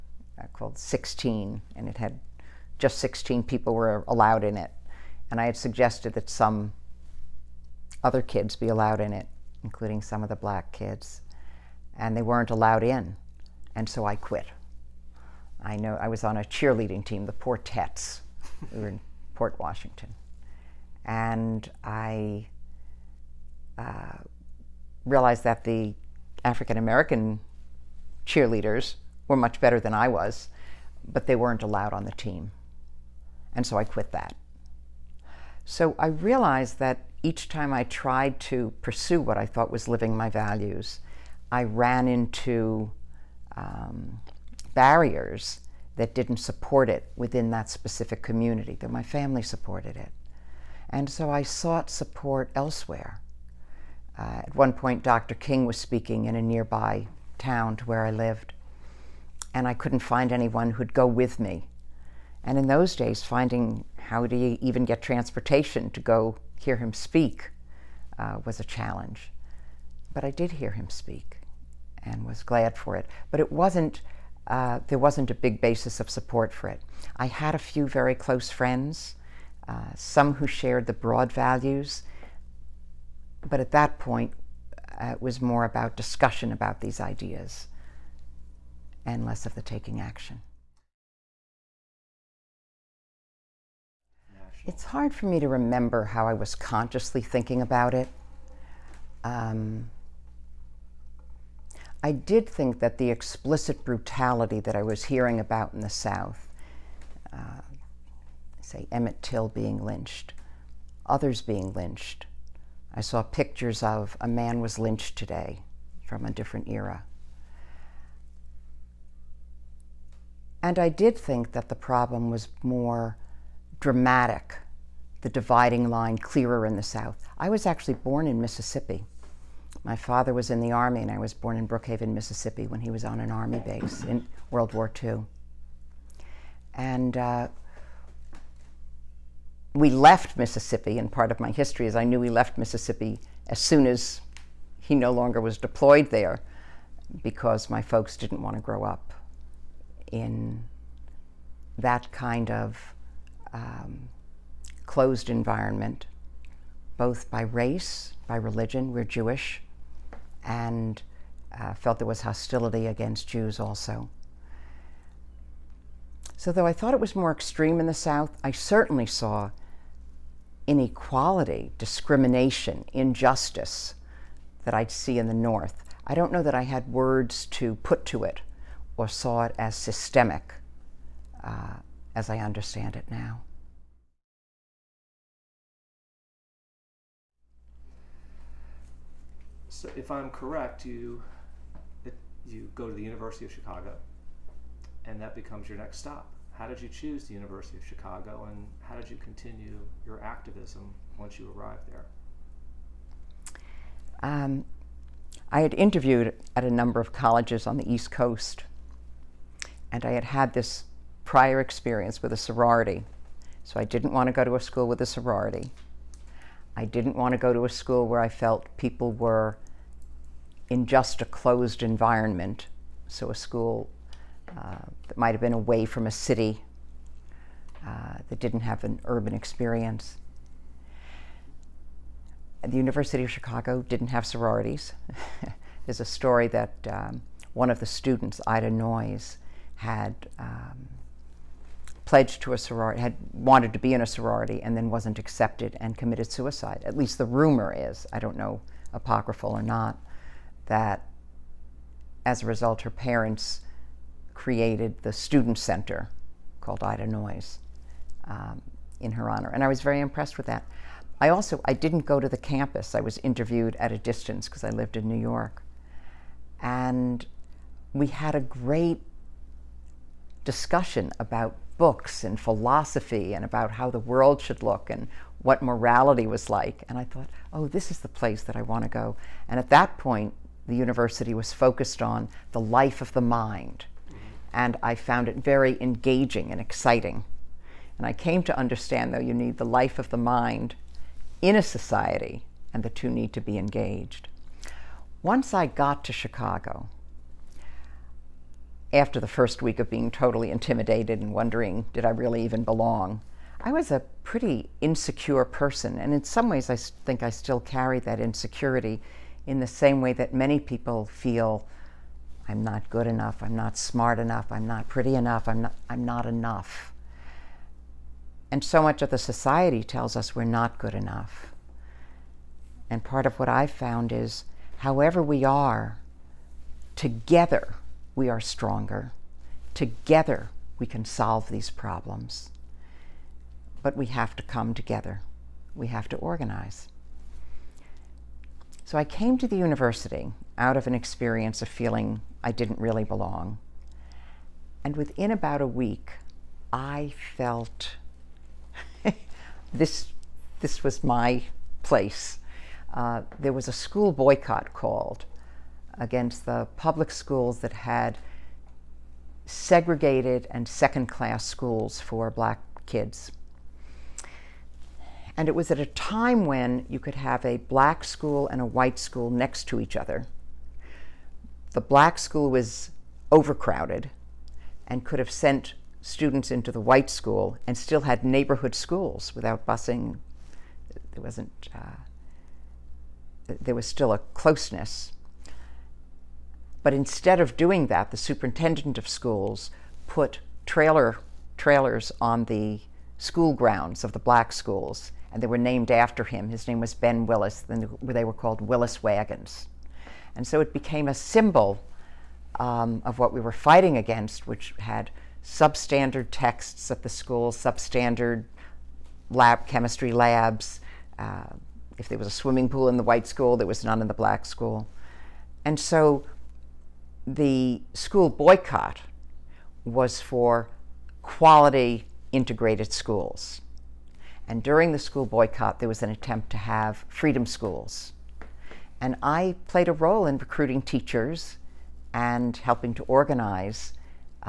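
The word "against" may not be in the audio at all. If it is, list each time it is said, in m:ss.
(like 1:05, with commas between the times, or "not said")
2:42, 5:55, 6:43.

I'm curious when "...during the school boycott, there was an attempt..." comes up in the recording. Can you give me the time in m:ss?
7:04.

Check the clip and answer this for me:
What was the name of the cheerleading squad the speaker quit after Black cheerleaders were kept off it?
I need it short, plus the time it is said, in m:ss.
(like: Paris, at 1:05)
Portettes, at 0:17.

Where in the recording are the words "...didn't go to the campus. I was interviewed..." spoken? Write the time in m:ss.
4:21.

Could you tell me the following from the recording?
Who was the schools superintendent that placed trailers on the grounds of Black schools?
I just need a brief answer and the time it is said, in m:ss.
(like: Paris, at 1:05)
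Ben Willis, at 6:36.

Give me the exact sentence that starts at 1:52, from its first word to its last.
I saw pictures of a man was lynched today from a different era.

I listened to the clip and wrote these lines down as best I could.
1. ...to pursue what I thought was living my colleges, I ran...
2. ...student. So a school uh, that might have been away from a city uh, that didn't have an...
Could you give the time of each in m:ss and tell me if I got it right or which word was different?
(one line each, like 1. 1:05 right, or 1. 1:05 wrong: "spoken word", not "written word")
1. 0:38 wrong: "values", not "colleges"
2. 3:41 wrong: "environment", not "student".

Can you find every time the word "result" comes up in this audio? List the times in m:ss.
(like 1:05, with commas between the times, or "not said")
4:12.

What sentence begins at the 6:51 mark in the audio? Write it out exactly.
Uh, if there was a swimming pool in the white school, there was none in the black school.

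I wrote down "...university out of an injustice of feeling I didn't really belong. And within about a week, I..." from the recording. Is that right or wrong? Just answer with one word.
wrong.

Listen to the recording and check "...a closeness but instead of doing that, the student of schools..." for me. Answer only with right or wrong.
wrong.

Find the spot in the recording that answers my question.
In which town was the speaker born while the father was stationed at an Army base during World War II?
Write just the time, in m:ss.
2:11.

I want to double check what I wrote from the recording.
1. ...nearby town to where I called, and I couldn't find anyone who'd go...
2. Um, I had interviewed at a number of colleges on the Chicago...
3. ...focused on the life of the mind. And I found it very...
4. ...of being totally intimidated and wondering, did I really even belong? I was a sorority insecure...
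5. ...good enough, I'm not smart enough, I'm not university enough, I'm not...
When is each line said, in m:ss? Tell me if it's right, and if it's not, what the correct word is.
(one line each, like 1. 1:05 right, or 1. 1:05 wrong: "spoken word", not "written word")
1. 0:56 wrong: "lived", not "called"
2. 3:24 wrong: "East", not "Chicago"
3. 4:41 right
4. 4:59 wrong: "pretty", not "sorority"
5. 5:12 wrong: "pretty", not "university".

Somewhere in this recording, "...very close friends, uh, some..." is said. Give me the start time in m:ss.
1:17.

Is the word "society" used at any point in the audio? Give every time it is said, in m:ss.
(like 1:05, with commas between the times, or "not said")
4:51, 5:19.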